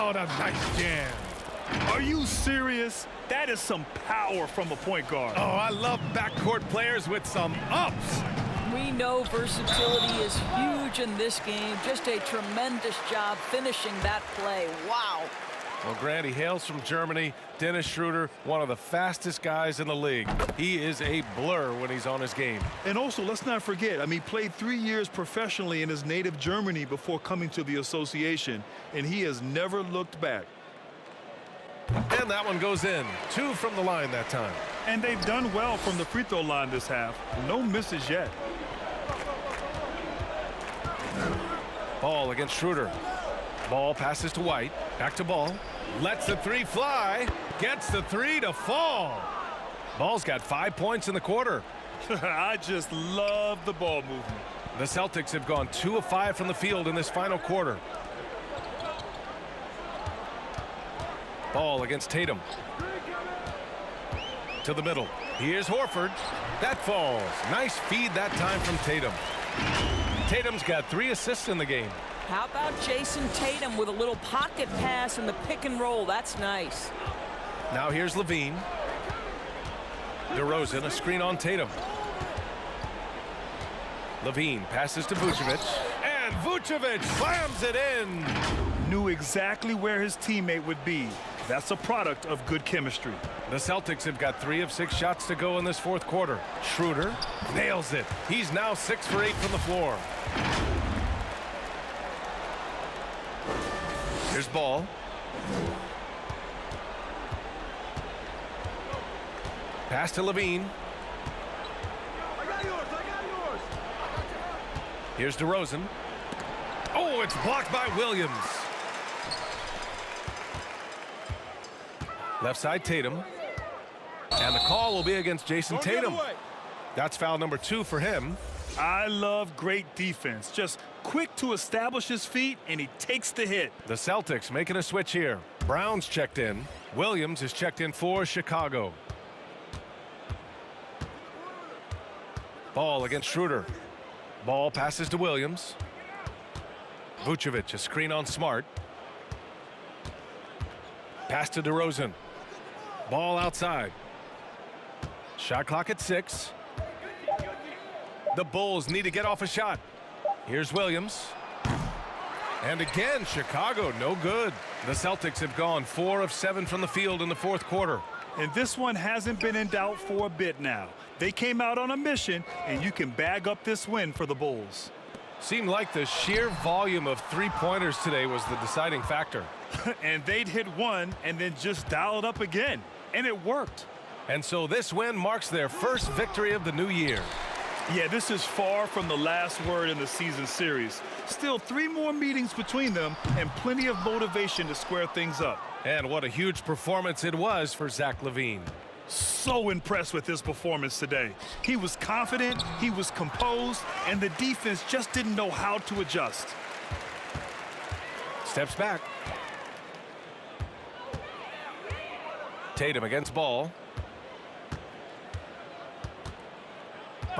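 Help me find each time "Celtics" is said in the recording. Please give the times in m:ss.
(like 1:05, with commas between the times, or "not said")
0:54, 1:33, 2:13, 2:44.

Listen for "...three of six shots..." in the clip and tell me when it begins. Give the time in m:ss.
1:34.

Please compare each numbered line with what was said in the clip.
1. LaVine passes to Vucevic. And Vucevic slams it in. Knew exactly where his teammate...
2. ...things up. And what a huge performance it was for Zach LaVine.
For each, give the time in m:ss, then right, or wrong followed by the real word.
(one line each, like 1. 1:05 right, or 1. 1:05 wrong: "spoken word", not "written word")
1. 1:24 right
2. 3:15 right.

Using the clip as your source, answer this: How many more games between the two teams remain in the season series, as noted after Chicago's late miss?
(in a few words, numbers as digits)
3.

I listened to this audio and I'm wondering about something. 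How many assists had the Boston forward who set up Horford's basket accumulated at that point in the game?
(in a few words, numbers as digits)
3.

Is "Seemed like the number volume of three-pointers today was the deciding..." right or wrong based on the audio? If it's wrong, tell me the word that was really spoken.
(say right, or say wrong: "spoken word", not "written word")
wrong: "sheer", not "number".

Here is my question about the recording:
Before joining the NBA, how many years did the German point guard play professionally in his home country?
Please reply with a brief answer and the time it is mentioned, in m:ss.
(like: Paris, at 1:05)
3, at 0:24.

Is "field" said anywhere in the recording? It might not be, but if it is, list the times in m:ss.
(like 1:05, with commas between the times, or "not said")
0:56, 2:46.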